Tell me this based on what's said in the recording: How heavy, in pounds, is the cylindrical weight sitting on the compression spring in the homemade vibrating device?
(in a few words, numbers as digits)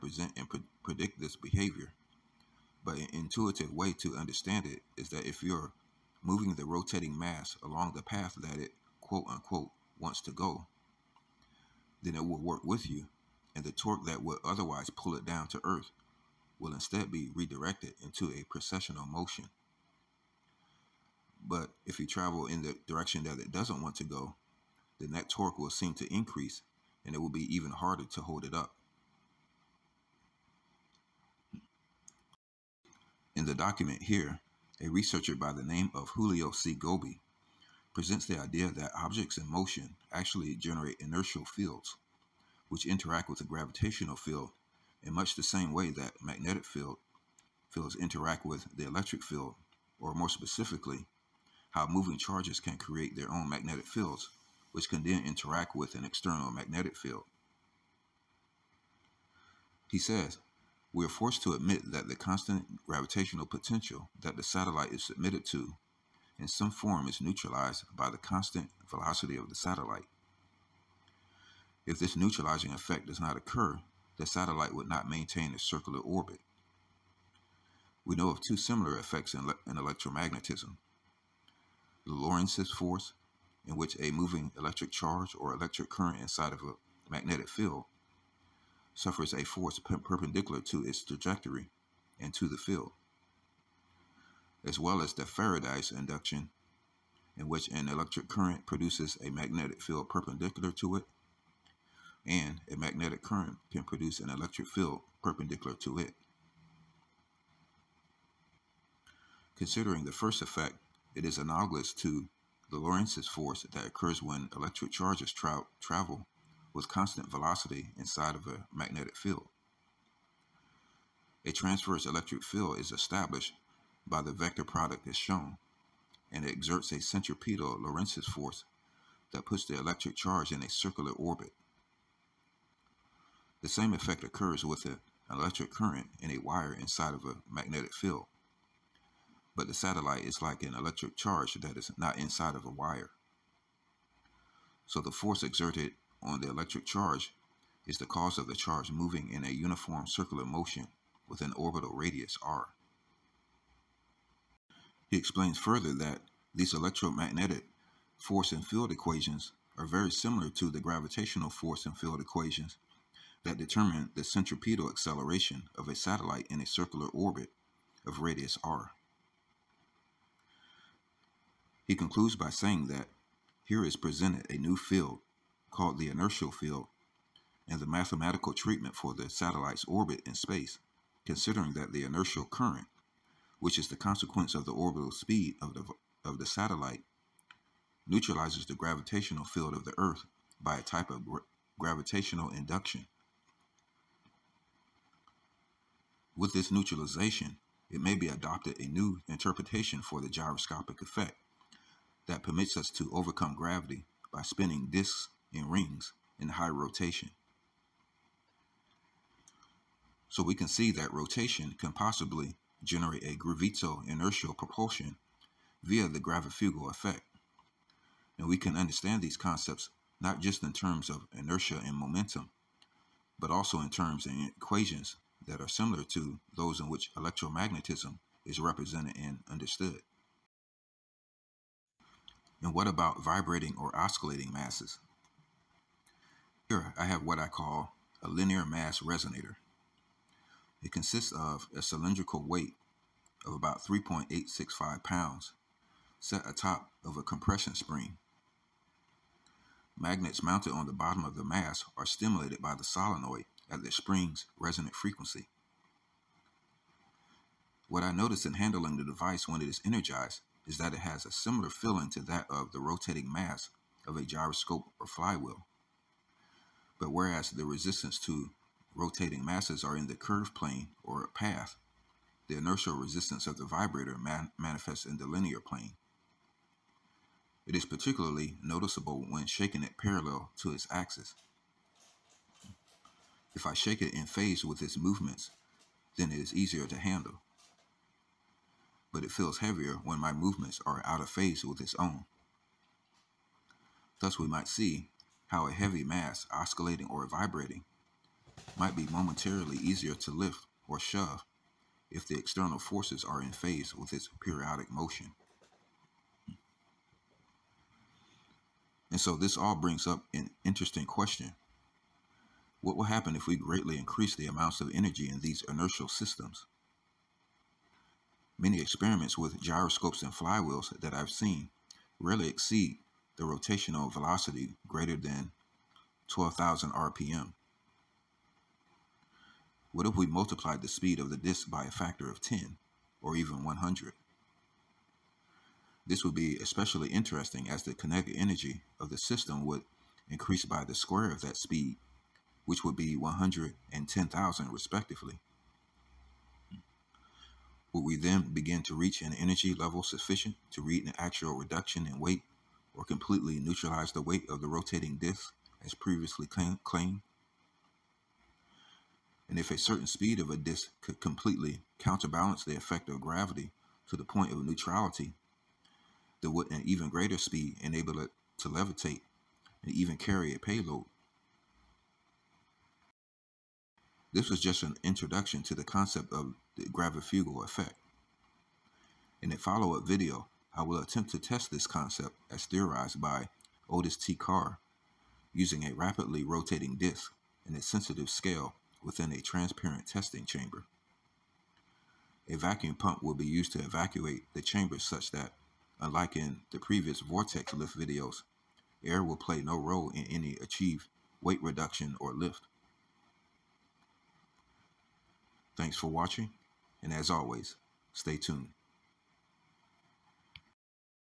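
3.865 pounds.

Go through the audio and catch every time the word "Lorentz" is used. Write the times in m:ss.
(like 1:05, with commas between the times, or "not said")
1:22, 1:52, 2:07.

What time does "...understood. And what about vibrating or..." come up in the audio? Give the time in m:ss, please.
3:49.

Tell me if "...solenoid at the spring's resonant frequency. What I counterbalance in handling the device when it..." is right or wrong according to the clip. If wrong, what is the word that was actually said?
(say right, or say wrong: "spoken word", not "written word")
wrong: "notice", not "counterbalance".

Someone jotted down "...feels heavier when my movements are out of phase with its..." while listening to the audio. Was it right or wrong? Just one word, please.
right.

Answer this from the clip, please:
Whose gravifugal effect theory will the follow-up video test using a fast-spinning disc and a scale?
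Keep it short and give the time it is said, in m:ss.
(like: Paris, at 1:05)
Otis T. Carr, at 6:23.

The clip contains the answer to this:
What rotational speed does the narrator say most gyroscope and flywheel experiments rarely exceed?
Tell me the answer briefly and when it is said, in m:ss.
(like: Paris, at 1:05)
12,000 RPM, at 5:26.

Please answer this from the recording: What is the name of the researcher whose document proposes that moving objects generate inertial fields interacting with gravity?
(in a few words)
Julio C. Gobi.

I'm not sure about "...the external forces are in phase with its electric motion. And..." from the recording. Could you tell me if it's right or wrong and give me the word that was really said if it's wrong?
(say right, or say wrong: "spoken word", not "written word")
wrong: "periodic", not "electric".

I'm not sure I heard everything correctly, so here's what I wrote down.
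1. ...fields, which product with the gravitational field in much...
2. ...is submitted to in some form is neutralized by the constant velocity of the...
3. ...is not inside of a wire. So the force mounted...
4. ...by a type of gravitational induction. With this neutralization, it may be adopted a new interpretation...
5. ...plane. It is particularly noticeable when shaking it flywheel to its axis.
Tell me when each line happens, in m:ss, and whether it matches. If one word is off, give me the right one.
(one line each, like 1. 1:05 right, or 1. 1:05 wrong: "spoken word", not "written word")
1. 0:41 wrong: "interact", not "product"
2. 1:04 right
3. 2:21 wrong: "exerted", not "mounted"
4. 3:10 right
5. 4:35 wrong: "parallel", not "flywheel".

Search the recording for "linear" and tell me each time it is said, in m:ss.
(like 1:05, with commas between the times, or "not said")
3:58, 4:35.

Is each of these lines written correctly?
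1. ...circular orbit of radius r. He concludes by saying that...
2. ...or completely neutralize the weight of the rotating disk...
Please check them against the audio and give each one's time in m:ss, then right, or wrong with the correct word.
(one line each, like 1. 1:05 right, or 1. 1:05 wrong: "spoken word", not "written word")
1. 2:46 right
2. 5:52 right.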